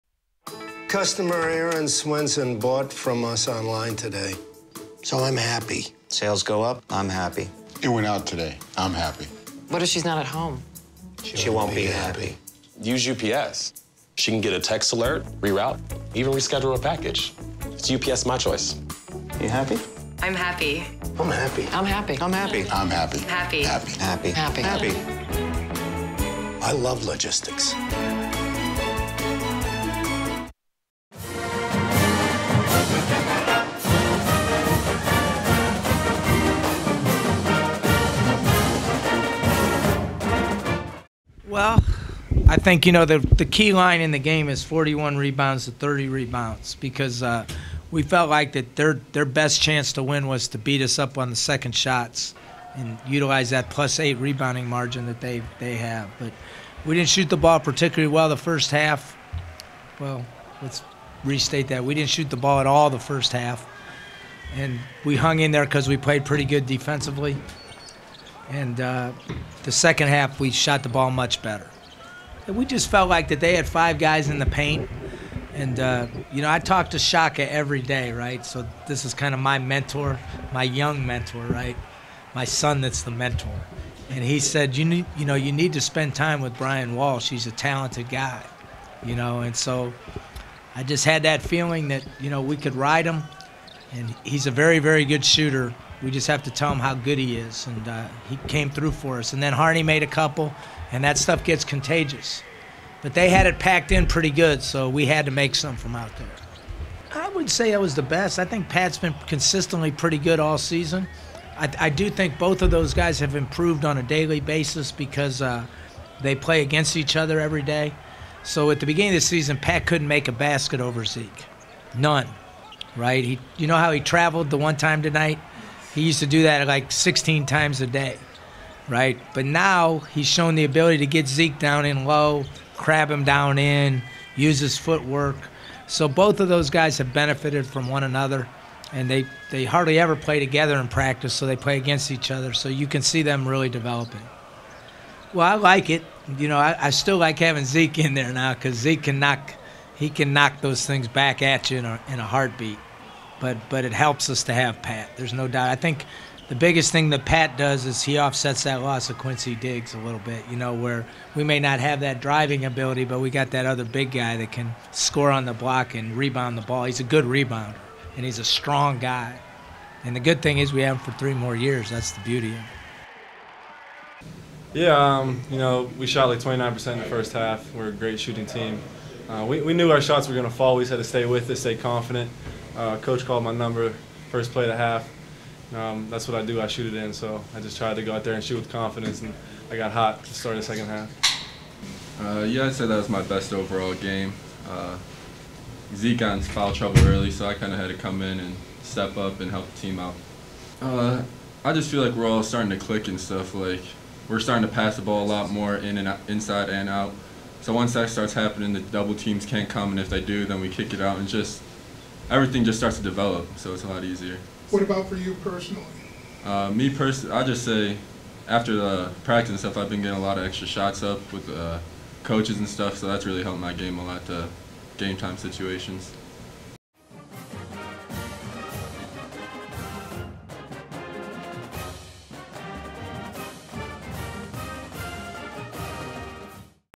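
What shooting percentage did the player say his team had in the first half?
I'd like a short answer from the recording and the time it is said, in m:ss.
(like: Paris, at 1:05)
29%, at 2:56.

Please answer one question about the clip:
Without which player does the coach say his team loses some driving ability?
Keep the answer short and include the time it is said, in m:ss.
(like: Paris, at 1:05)
Quincy Diggs, at 2:39.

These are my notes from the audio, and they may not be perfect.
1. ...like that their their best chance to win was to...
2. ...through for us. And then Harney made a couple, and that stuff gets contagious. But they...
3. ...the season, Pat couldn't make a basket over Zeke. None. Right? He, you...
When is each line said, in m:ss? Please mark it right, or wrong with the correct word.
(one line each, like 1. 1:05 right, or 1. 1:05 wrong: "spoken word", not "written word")
1. 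0:48 right
2. 1:38 right
3. 1:59 right.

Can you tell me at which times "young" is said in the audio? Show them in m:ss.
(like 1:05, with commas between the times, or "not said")
1:20.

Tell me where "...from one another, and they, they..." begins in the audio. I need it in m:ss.
2:17.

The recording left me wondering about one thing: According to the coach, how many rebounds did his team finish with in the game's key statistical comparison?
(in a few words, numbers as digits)
41.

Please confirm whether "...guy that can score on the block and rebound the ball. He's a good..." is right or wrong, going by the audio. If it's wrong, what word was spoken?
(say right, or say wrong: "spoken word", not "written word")
right.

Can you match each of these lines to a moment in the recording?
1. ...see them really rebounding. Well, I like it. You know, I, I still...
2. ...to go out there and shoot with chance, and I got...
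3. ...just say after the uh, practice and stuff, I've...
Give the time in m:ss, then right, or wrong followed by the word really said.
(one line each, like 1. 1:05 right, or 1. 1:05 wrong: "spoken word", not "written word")
1. 2:23 wrong: "developing", not "rebounding"
2. 3:07 wrong: "confidence", not "chance"
3. 3:37 right.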